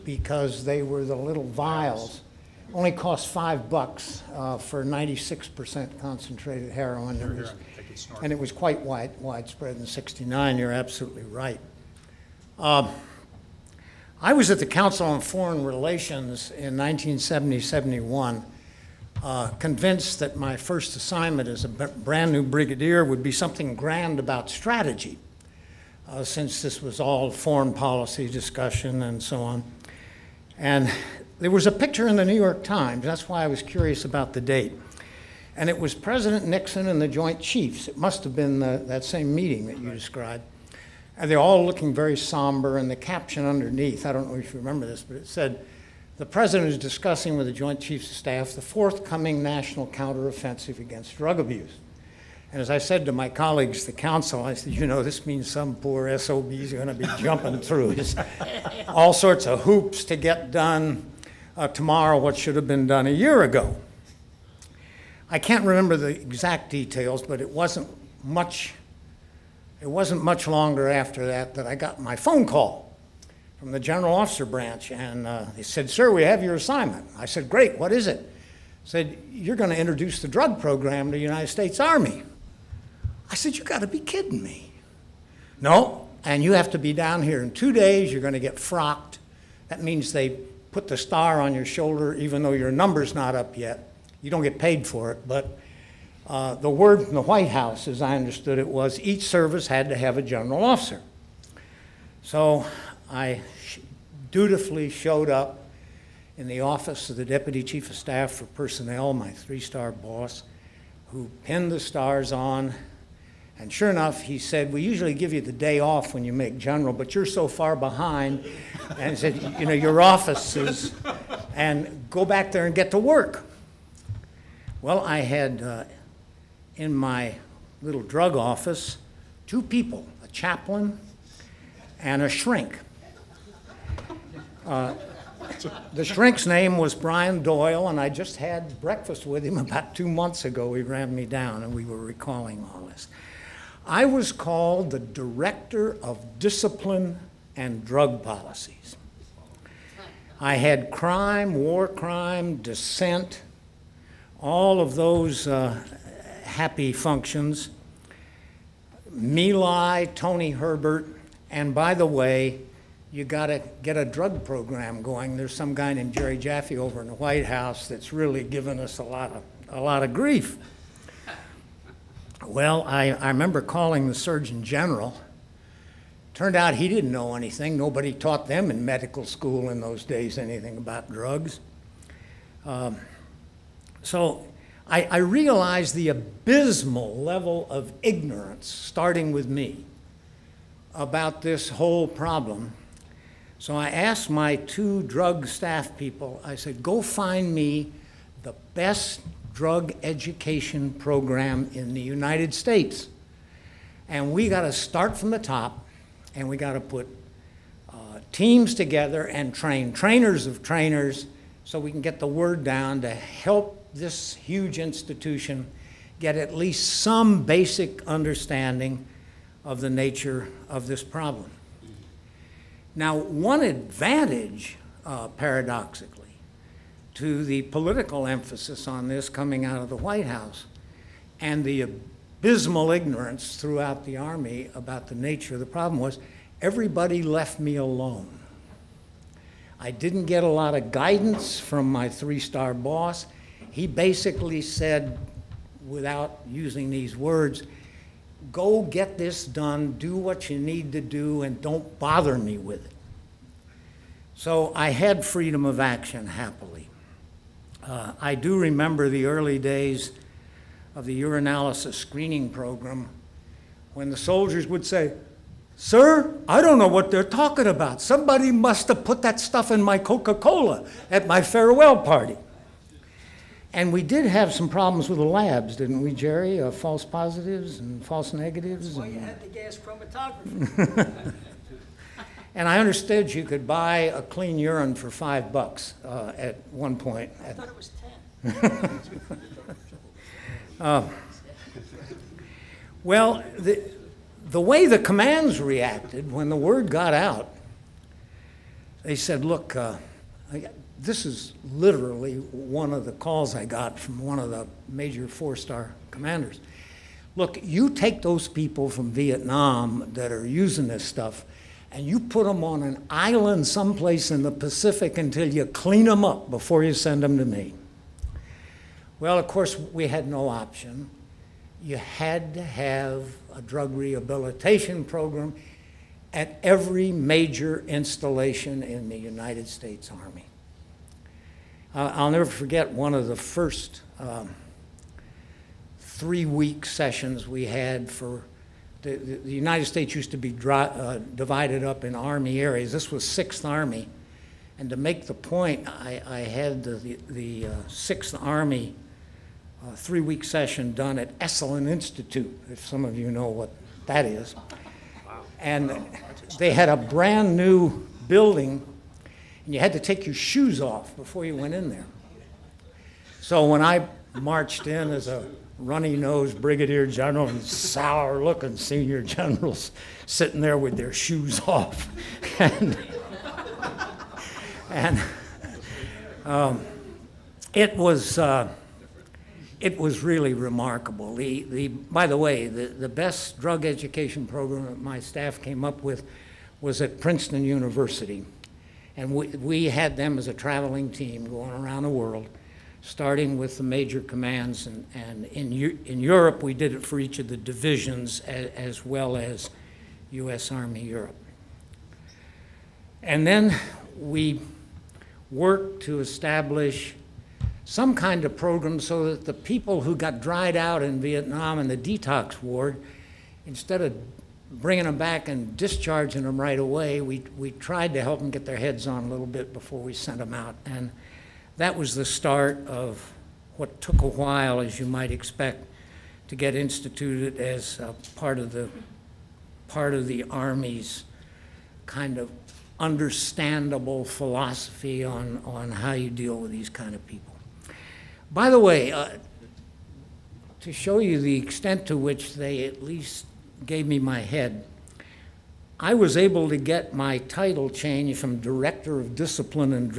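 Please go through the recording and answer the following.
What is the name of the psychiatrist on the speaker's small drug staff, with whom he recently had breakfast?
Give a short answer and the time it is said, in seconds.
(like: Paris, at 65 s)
Brian Doyle, at 136 s.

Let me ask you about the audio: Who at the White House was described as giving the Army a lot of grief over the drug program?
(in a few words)
Jerry Jaffe.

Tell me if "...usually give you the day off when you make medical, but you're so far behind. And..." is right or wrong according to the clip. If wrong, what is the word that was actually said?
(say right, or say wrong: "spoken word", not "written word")
wrong: "general", not "medical".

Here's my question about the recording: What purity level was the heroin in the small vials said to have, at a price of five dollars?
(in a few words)
96%.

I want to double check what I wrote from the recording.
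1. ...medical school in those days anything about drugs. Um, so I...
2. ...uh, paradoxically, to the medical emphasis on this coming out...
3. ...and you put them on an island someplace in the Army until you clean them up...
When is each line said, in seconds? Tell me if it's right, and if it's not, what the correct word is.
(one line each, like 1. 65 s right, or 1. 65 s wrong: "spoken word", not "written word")
1. 178 s right
2. 225 s wrong: "political", not "medical"
3. 311 s wrong: "Pacific", not "Army".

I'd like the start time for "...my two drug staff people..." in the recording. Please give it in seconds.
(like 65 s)
194 s.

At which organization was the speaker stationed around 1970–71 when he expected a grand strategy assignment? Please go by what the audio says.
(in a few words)
Council on Foreign Relations.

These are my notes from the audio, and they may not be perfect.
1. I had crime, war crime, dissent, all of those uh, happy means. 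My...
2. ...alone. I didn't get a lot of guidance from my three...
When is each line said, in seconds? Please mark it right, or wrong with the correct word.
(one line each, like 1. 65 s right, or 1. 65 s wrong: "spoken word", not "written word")
1. 150 s wrong: "functions", not "means"
2. 237 s right.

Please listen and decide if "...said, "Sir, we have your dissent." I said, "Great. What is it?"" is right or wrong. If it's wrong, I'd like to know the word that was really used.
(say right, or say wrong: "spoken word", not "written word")
wrong: "assignment", not "dissent".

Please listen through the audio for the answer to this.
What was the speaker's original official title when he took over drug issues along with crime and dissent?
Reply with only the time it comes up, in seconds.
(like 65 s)
144 s.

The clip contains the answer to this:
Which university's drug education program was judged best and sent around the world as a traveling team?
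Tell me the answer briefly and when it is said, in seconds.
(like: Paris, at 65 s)
Princeton University, at 387 s.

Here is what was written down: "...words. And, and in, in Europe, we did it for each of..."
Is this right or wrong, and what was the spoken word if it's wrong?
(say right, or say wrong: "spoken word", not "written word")
wrong: "commands", not "words".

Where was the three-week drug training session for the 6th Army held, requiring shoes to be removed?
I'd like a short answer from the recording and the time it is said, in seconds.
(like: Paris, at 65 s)
Esalen Institute, at 351 s.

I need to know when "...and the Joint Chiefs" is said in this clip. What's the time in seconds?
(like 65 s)
36 s.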